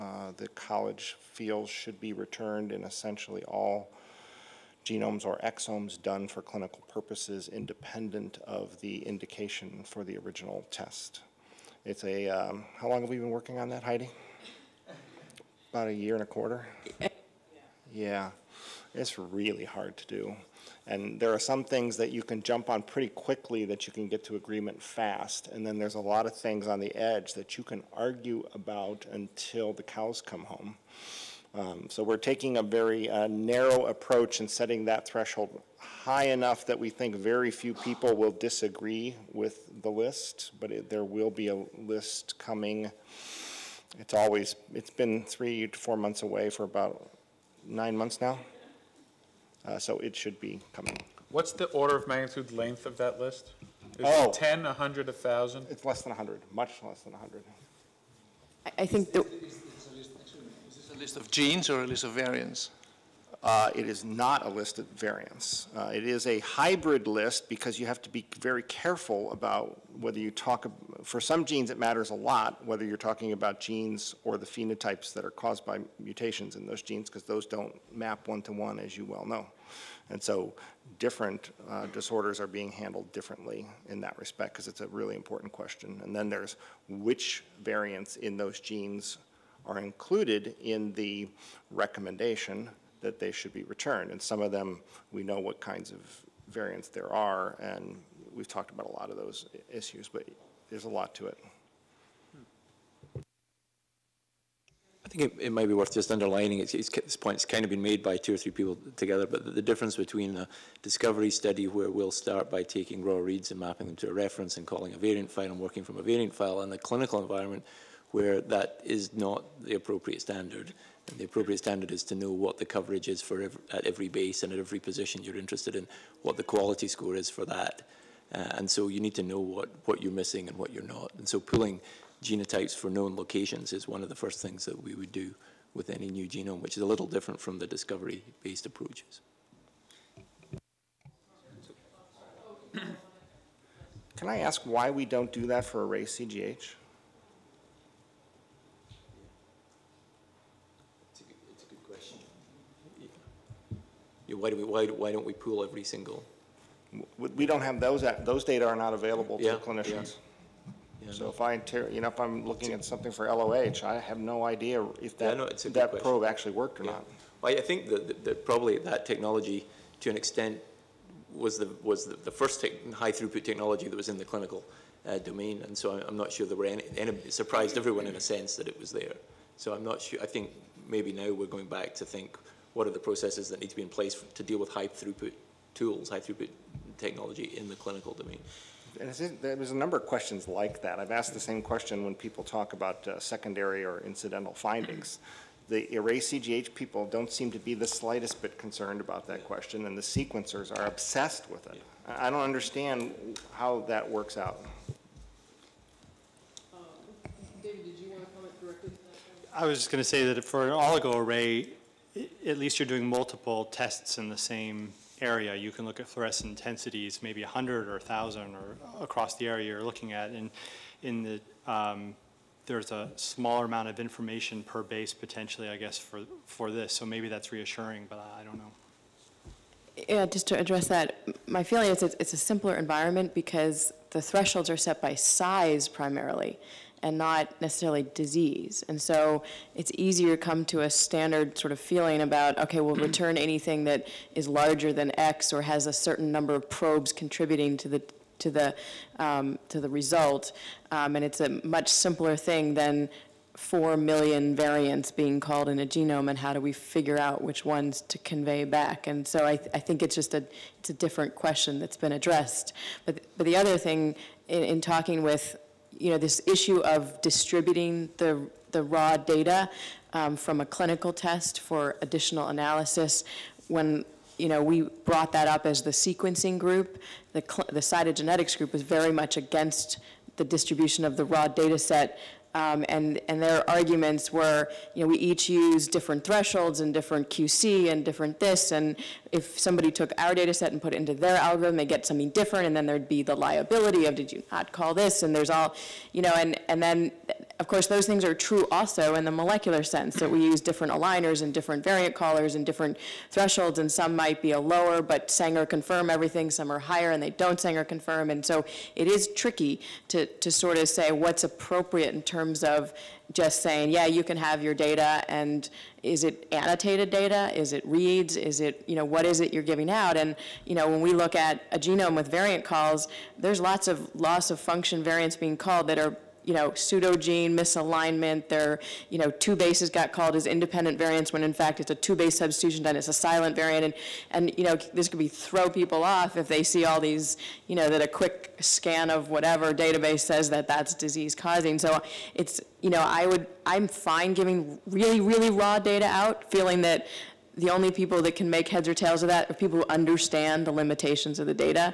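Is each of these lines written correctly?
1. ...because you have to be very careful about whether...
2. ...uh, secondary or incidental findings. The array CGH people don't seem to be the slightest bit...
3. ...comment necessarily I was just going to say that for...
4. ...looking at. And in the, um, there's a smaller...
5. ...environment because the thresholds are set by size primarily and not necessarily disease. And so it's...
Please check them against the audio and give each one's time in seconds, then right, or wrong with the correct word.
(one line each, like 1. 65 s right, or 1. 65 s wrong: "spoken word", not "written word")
1. 67 s right
2. 193 s right
3. 208 s wrong: "directly", not "necessarily"
4. 219 s right
5. 232 s right.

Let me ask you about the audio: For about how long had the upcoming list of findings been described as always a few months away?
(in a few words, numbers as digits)
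About nine months.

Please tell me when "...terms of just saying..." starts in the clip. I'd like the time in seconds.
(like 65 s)
312 s.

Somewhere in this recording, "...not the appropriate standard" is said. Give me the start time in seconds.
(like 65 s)
119 s.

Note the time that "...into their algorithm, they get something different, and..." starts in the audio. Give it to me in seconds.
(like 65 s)
290 s.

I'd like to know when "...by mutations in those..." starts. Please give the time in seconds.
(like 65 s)
75 s.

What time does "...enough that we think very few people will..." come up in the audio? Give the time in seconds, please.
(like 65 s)
36 s.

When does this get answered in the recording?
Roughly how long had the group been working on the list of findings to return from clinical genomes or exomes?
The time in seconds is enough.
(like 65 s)
15 s.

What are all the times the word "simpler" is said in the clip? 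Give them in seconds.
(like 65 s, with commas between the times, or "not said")
232 s, 251 s.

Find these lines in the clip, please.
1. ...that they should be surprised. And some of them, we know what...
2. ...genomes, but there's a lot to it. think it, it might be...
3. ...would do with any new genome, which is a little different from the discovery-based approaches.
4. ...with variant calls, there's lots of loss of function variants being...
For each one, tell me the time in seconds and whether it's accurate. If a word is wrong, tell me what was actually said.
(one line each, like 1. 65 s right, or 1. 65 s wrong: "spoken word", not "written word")
1. 92 s wrong: "returned", not "surprised"
2. 99 s wrong: "issues", not "genomes"
3. 134 s right
4. 322 s right.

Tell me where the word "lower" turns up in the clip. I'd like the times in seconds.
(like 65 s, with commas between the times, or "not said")
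304 s.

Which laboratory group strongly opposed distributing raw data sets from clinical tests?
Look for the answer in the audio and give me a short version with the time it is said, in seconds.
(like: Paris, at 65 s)
The cytogenetics group, at 277 s.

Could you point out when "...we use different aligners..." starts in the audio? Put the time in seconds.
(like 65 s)
300 s.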